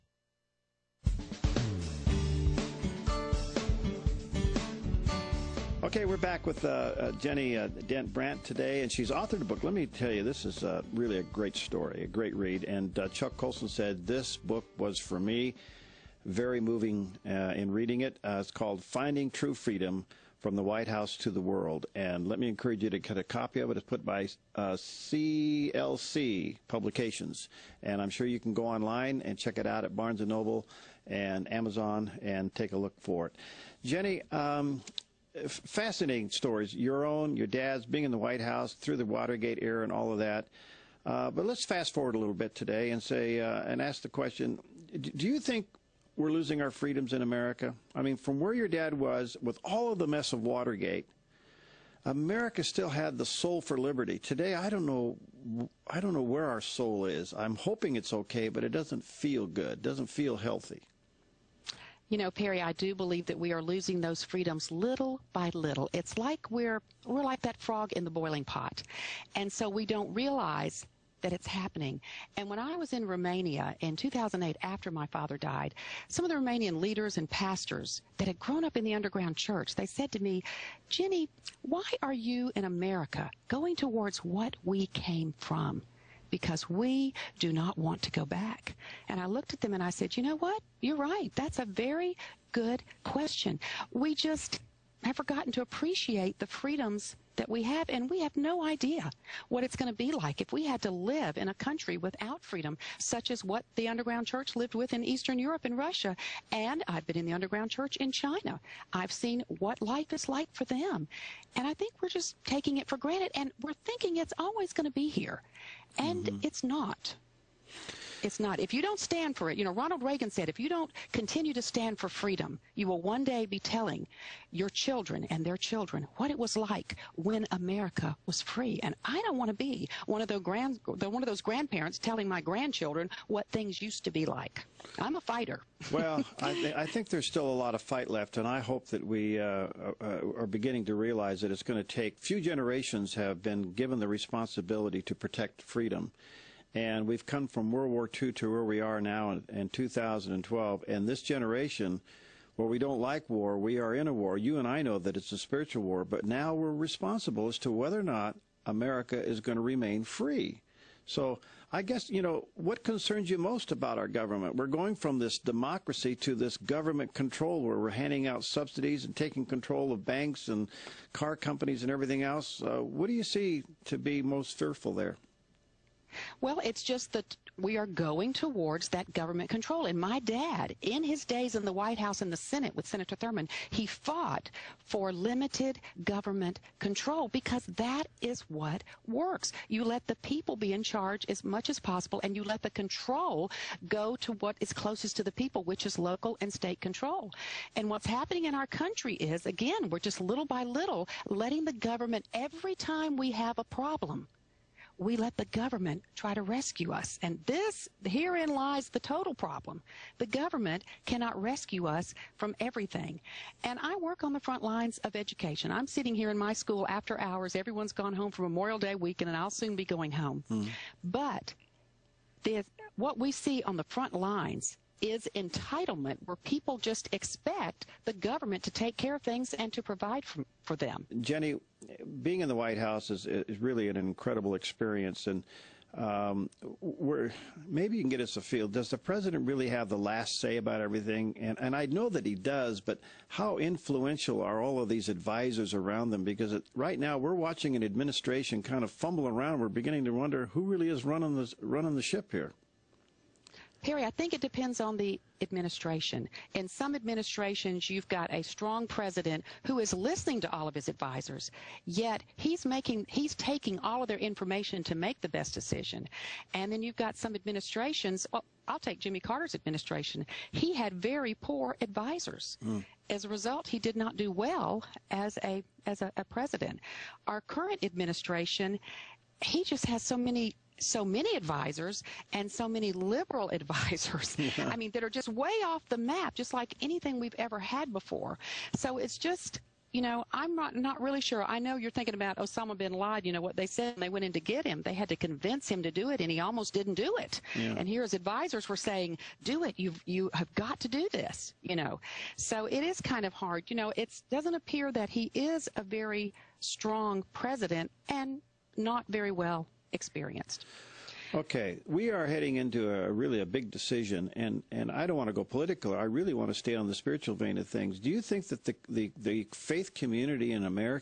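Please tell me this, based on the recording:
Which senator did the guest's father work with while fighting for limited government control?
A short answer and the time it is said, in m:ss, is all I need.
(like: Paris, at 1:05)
Senator Thurmond, at 3:02.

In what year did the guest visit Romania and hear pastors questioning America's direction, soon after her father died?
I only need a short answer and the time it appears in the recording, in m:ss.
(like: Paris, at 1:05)
2008, at 1:13.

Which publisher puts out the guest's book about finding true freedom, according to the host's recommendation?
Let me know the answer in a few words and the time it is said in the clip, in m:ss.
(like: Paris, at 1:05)
CLC Publications, at 0:24.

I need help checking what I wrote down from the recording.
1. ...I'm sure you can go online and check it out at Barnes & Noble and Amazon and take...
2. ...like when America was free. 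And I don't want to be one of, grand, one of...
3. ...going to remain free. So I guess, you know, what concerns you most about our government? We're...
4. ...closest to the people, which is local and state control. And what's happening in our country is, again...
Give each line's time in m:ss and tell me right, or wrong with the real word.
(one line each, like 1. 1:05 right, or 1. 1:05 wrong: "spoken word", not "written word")
1. 0:28 right
2. 2:06 right
3. 2:39 right
4. 3:14 right.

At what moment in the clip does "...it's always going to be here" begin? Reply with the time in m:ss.
1:54.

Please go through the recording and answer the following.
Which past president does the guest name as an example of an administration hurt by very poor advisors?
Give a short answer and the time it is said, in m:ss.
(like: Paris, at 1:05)
Jimmy Carter, at 4:28.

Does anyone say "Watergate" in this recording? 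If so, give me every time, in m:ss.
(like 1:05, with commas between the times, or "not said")
0:39, 0:50.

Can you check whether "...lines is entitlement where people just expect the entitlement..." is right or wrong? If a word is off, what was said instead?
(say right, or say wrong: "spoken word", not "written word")
wrong: "government", not "entitlement".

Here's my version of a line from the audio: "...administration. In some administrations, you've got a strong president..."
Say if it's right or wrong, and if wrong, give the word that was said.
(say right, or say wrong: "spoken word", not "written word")
right.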